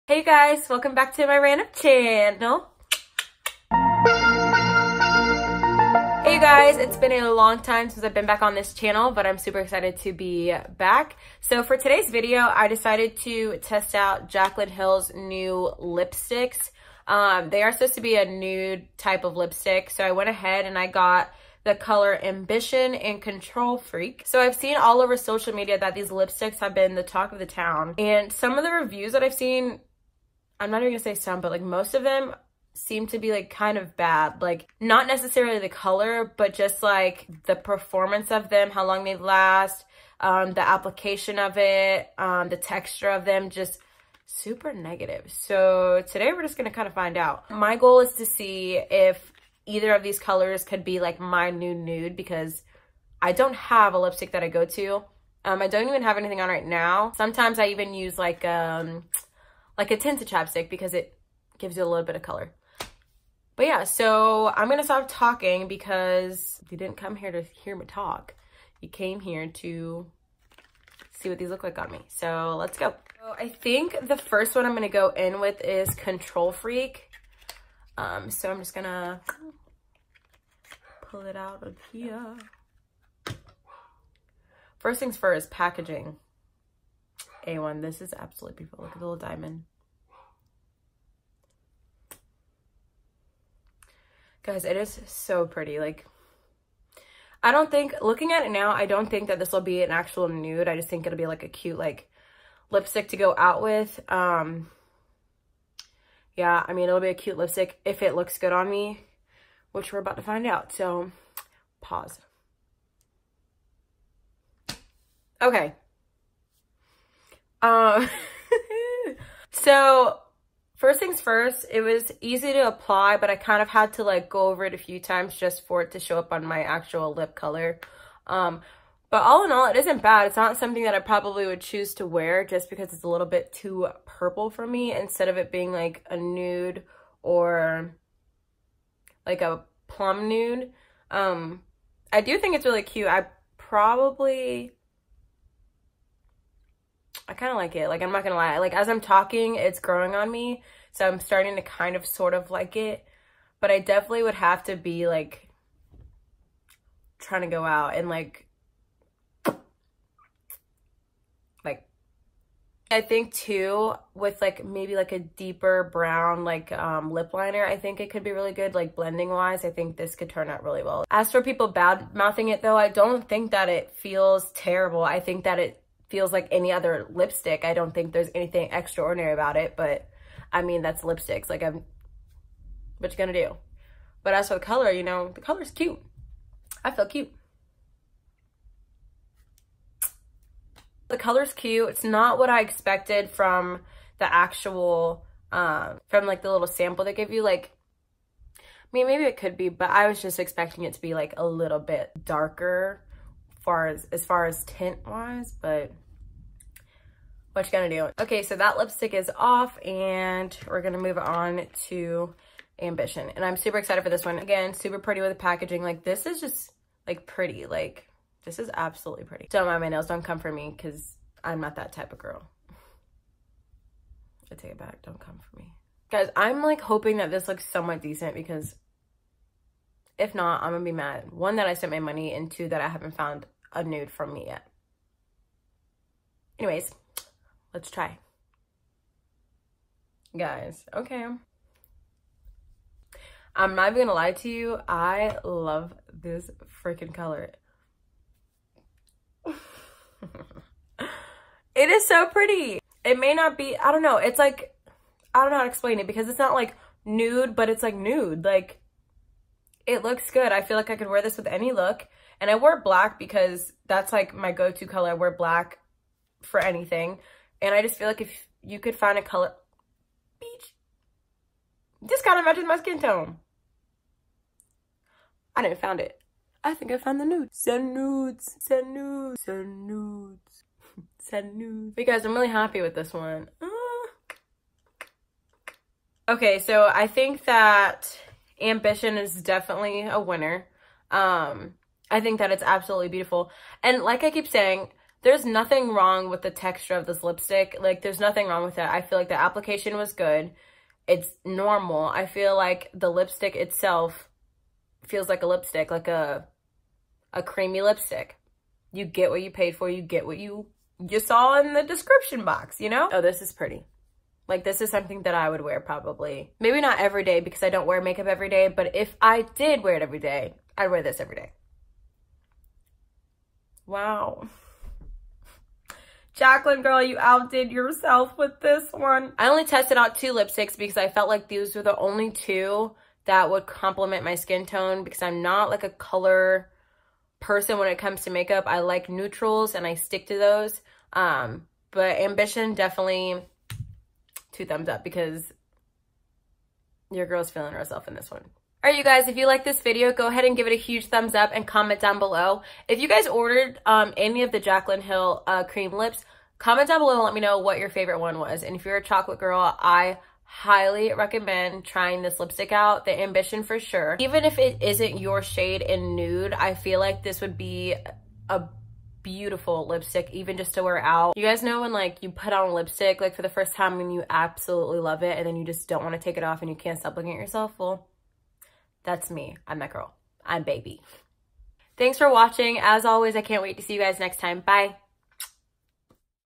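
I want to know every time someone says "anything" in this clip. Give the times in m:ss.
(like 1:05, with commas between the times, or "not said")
0:56, 2:58, 4:26.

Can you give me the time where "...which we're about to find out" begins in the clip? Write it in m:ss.
1:49.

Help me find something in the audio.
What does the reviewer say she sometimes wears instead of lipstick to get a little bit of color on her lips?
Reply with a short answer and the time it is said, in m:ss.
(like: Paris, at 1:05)
tinted chapstick, at 0:59.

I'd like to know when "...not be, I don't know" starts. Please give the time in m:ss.
4:13.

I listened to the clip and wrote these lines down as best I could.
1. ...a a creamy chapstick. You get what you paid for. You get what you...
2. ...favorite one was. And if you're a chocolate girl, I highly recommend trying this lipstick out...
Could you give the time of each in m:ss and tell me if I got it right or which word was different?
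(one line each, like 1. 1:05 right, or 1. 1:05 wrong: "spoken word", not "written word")
1. 5:06 wrong: "lipstick", not "chapstick"
2. 5:57 right.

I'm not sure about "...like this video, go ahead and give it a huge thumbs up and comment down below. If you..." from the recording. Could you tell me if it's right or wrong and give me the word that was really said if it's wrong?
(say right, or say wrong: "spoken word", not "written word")
right.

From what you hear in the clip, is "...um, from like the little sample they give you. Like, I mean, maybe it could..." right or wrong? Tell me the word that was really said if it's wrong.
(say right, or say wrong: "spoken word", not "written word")
right.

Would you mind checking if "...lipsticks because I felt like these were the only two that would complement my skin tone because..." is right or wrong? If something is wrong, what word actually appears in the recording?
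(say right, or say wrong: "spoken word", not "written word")
right.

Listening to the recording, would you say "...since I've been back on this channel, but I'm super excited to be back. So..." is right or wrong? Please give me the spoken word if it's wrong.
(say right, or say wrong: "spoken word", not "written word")
right.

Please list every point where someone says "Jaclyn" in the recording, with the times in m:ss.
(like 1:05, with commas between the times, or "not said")
0:14, 5:26, 5:54.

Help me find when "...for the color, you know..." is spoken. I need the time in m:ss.
3:04.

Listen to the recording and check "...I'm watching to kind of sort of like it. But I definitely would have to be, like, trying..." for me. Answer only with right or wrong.
wrong.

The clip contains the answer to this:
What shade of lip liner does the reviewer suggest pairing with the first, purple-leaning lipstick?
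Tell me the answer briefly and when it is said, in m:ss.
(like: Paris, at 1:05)
deeper brown, at 2:45.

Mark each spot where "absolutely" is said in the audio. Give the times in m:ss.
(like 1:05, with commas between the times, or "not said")
1:28, 3:38, 4:52, 6:14.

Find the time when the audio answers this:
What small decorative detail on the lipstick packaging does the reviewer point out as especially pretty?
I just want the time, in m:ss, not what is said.
1:28.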